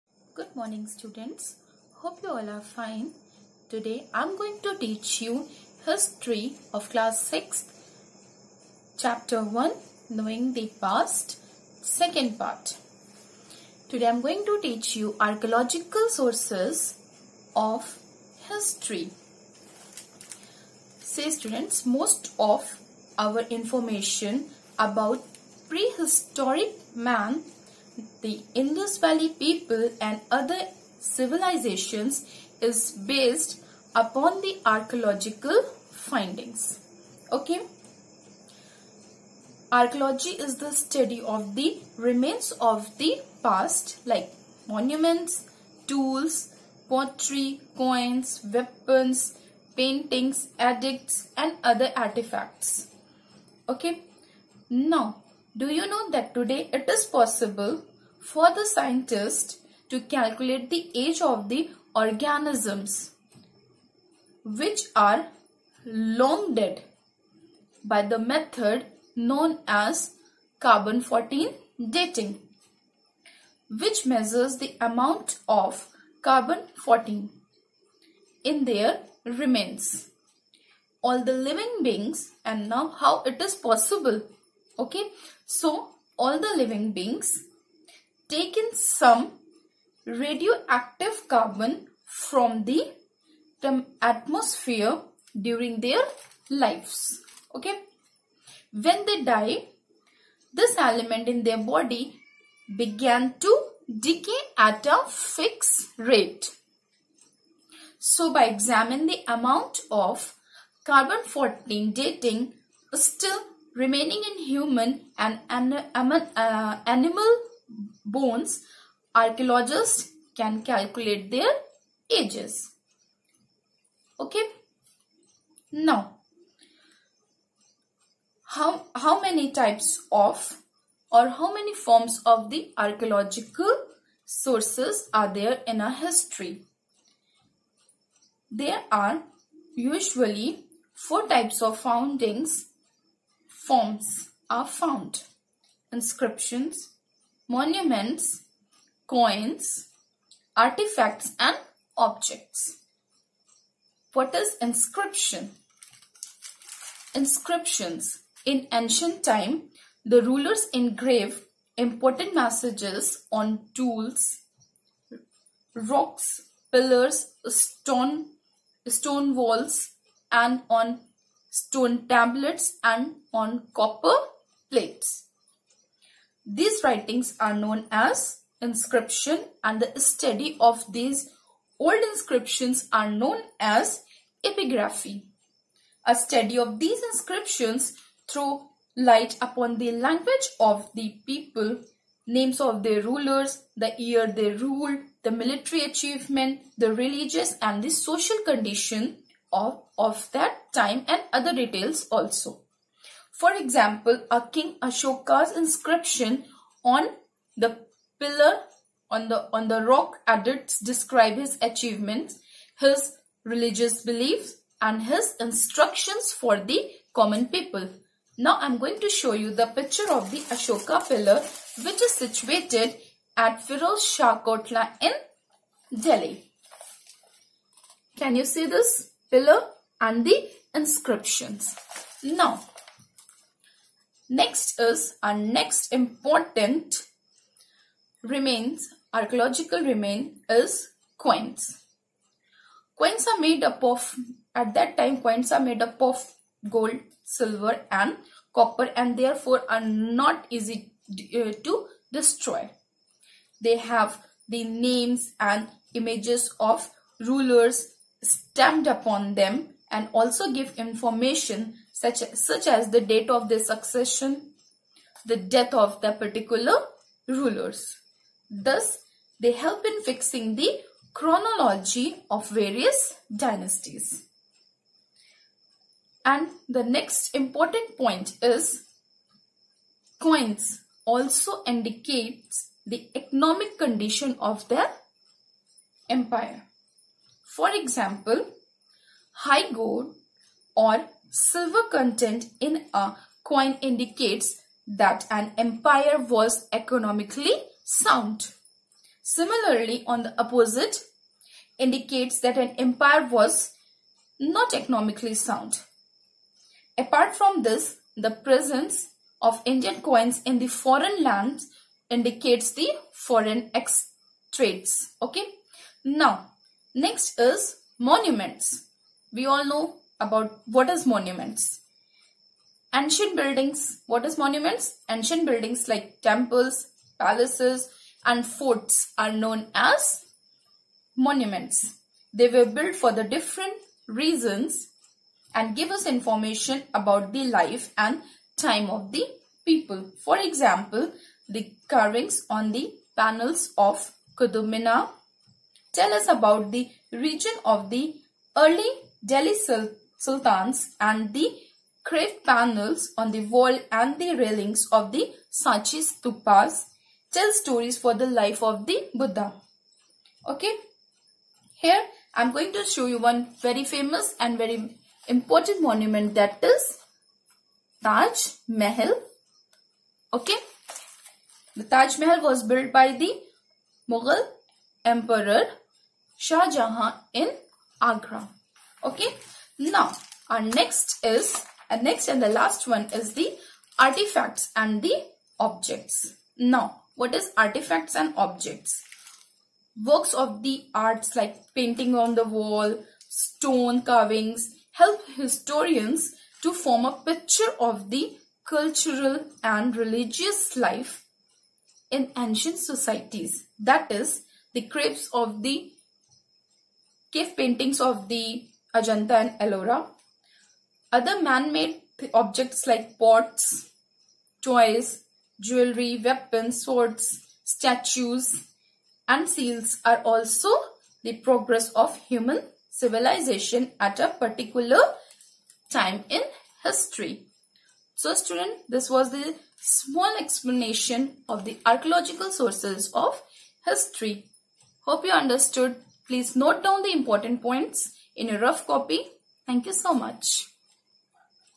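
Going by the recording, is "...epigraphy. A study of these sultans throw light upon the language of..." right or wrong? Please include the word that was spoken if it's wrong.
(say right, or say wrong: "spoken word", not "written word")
wrong: "inscriptions", not "sultans".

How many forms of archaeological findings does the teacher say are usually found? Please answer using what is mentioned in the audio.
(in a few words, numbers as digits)
4.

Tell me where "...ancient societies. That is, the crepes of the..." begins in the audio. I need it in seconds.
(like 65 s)
402 s.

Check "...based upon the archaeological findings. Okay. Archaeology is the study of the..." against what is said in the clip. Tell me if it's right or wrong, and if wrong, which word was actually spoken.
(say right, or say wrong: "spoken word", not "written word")
right.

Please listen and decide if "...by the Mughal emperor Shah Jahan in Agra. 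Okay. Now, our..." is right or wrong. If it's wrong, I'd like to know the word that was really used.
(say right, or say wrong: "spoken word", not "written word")
right.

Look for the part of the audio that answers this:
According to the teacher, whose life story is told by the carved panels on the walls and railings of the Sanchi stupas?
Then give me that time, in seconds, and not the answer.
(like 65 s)
358 s.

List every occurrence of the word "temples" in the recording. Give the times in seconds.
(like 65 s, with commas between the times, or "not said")
326 s.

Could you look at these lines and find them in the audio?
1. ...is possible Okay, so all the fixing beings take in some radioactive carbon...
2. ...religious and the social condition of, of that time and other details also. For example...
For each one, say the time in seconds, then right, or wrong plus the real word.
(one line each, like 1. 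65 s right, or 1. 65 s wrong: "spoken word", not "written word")
1. 83 s wrong: "living", not "fixing"
2. 196 s right.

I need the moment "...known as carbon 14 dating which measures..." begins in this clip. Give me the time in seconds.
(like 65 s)
69 s.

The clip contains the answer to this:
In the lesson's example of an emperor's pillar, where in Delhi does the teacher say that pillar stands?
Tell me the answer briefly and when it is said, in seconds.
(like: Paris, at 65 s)
Firoz Shah Kotla, at 223 s.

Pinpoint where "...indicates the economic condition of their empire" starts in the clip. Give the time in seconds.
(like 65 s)
281 s.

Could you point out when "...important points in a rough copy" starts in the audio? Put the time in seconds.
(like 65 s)
437 s.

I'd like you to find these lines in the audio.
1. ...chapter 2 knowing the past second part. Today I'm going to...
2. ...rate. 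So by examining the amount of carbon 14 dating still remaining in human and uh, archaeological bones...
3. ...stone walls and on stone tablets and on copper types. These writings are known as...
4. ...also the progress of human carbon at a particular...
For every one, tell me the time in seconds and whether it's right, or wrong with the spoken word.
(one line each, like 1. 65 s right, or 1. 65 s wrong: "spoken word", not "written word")
1. 9 s wrong: "1", not "2"
2. 105 s wrong: "animal", not "archaeological"
3. 168 s wrong: "plates", not "types"
4. 420 s wrong: "civilization", not "carbon".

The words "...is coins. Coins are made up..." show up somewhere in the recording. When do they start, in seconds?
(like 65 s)
240 s.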